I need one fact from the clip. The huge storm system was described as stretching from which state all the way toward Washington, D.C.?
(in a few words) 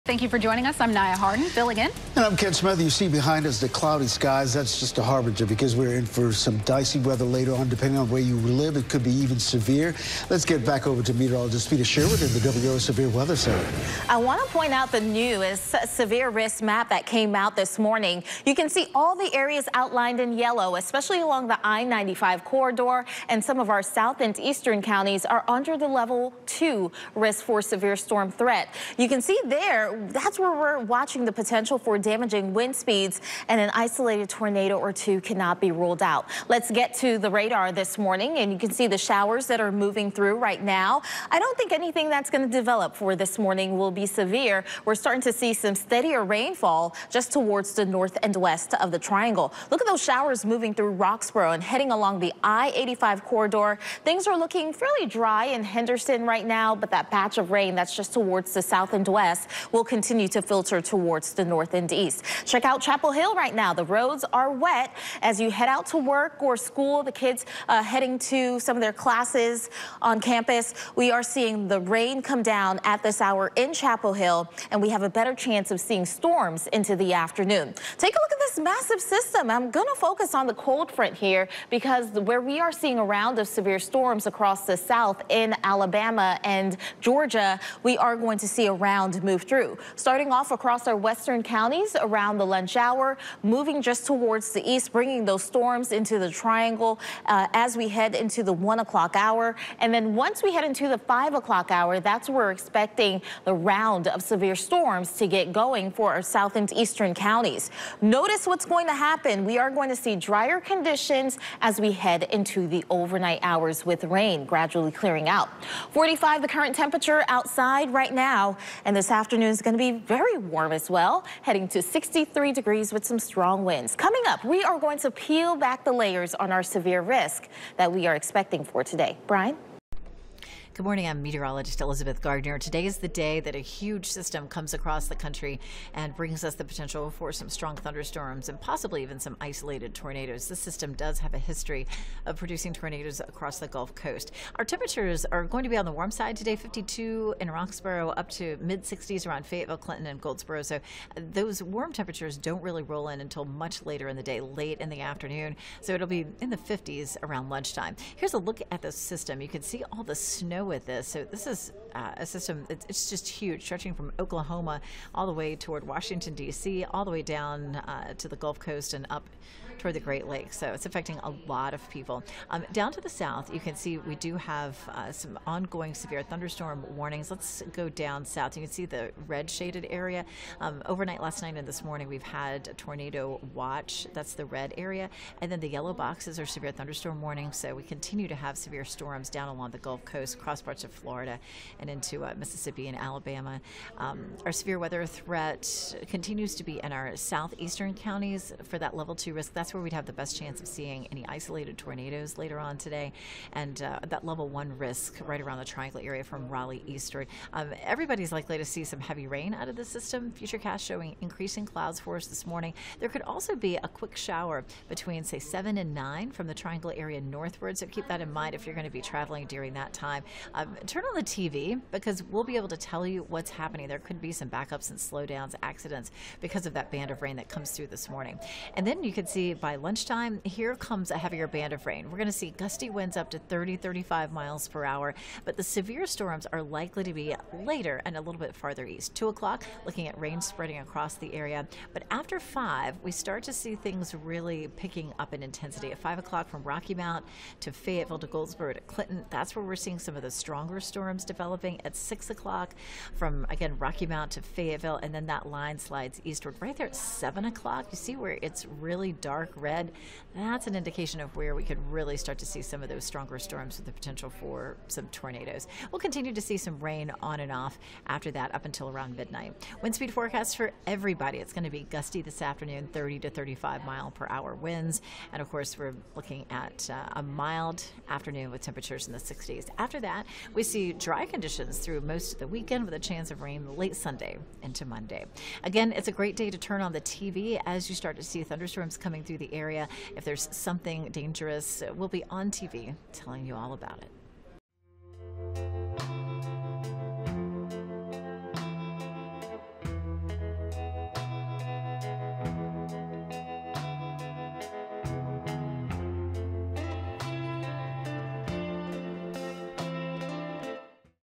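Oklahoma.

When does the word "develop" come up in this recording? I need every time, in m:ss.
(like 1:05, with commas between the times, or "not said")
0:42, 4:11.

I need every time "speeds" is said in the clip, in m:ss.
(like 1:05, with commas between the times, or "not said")
0:32, 4:29.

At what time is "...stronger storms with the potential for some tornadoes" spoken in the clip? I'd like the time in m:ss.
4:23.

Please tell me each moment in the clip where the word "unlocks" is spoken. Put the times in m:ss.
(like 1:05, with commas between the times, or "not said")
not said.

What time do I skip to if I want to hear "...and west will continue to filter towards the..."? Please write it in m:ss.
0:58.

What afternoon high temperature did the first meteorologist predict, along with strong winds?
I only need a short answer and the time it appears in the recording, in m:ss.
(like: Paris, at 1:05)
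63 degrees, at 2:01.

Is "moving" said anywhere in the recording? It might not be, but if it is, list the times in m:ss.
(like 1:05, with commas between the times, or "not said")
0:39, 0:50, 1:33.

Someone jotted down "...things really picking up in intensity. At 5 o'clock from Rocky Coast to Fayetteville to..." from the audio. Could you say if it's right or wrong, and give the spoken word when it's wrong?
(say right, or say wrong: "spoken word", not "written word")
wrong: "Mount", not "Coast".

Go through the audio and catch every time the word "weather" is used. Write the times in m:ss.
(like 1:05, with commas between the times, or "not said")
0:06, 0:13, 3:14.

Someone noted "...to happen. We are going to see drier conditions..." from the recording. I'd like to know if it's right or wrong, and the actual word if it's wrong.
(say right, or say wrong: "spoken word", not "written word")
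right.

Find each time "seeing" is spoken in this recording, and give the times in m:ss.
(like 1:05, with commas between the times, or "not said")
1:11, 1:15, 1:22, 3:20, 4:09.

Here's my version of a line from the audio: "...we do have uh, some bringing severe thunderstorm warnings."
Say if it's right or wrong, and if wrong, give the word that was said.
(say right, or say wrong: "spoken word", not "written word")
wrong: "ongoing", not "bringing".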